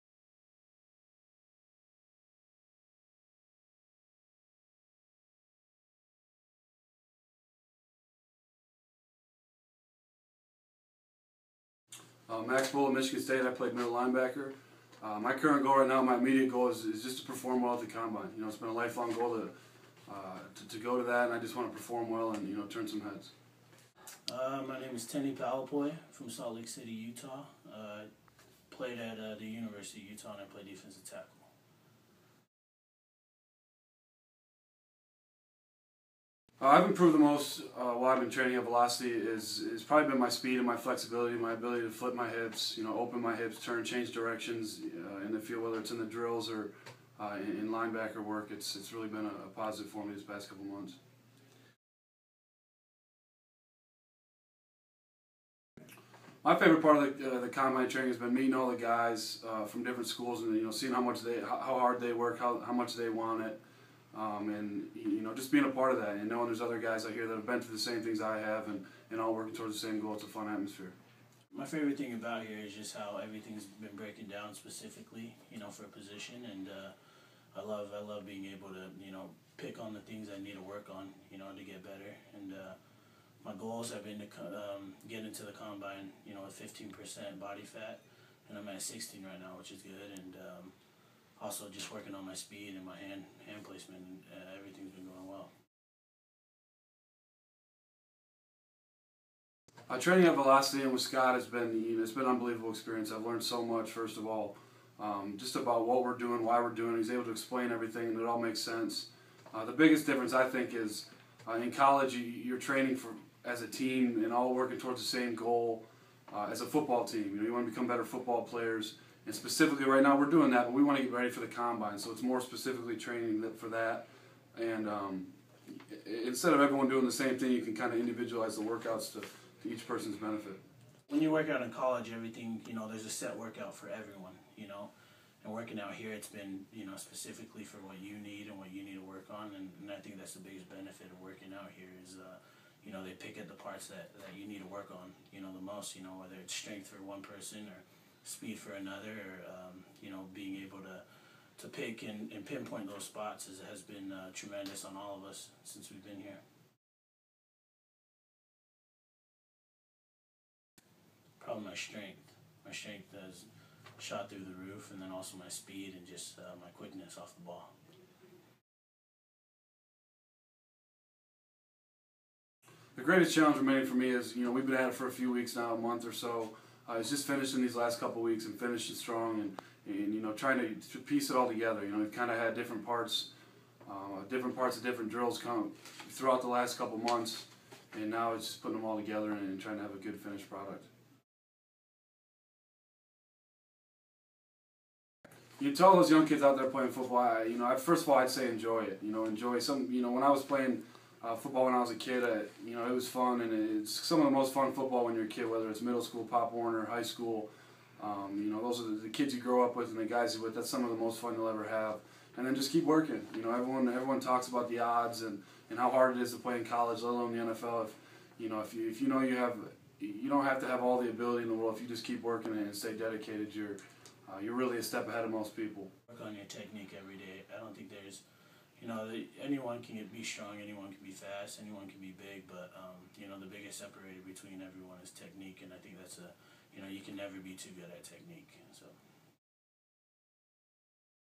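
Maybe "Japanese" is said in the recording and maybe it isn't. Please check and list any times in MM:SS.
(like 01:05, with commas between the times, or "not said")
not said.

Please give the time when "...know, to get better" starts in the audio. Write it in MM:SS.
01:21.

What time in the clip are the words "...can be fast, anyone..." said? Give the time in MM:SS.
03:50.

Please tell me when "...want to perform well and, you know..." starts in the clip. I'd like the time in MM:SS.
00:21.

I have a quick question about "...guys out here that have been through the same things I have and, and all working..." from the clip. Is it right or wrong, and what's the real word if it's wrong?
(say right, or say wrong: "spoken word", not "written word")
right.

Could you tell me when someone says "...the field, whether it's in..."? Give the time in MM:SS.
00:45.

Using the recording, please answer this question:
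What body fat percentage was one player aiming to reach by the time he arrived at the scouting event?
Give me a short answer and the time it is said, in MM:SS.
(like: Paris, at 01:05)
15%, at 01:26.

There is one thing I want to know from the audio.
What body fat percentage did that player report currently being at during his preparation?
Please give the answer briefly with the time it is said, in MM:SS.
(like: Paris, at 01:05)
16%, at 01:28.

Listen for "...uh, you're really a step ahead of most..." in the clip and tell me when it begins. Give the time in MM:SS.
03:44.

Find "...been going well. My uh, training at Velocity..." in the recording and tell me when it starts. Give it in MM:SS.
01:34.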